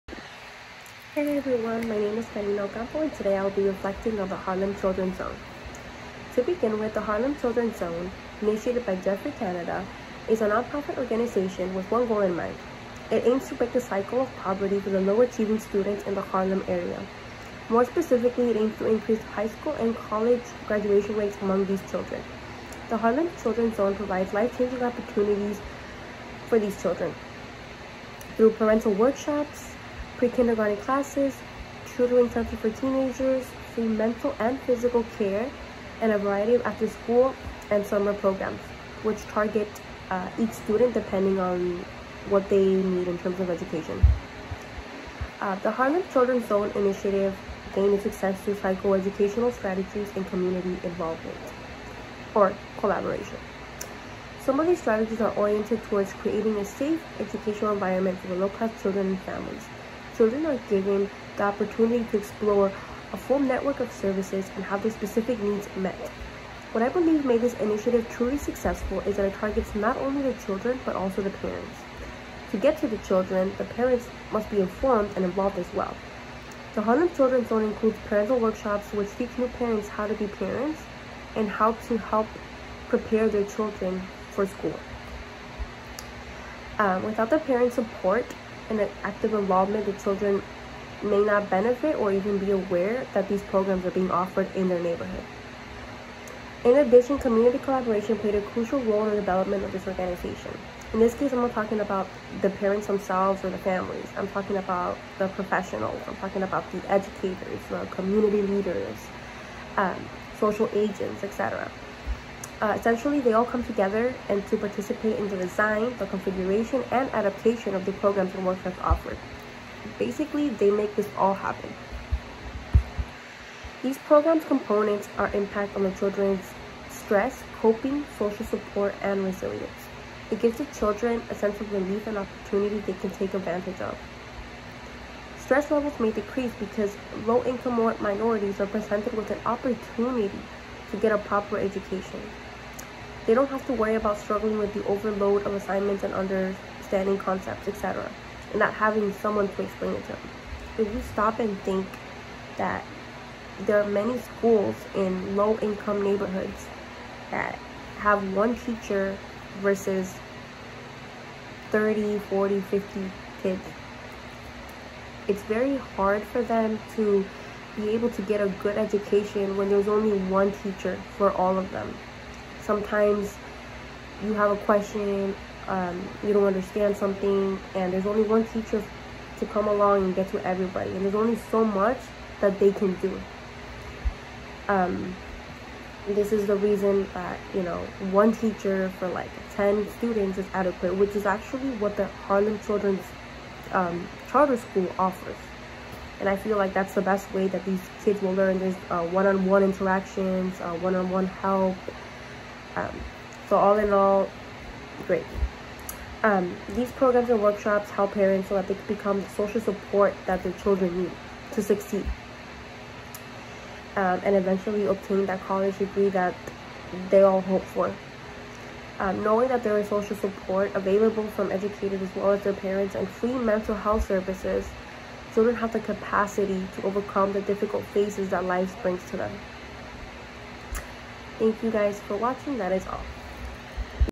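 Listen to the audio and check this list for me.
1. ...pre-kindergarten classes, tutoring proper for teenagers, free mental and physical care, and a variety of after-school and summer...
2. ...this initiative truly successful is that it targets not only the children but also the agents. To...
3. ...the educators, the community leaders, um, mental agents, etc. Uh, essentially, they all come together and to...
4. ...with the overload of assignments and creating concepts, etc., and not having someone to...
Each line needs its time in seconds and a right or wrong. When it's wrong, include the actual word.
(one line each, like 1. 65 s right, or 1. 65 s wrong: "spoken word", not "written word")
1. 30 s wrong: "center", not "proper"
2. 67 s wrong: "parents", not "agents"
3. 106 s wrong: "social", not "mental"
4. 144 s wrong: "understanding", not "creating".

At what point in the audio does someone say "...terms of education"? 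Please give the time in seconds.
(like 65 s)
43 s.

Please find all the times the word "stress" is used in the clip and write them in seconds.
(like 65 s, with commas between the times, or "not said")
126 s, 135 s.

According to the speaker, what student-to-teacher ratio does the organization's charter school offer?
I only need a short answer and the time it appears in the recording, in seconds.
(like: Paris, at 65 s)
1 teacher for 10 students, at 188 s.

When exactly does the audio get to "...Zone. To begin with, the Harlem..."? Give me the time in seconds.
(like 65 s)
5 s.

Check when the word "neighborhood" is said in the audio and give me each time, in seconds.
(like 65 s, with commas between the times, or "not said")
94 s, 156 s.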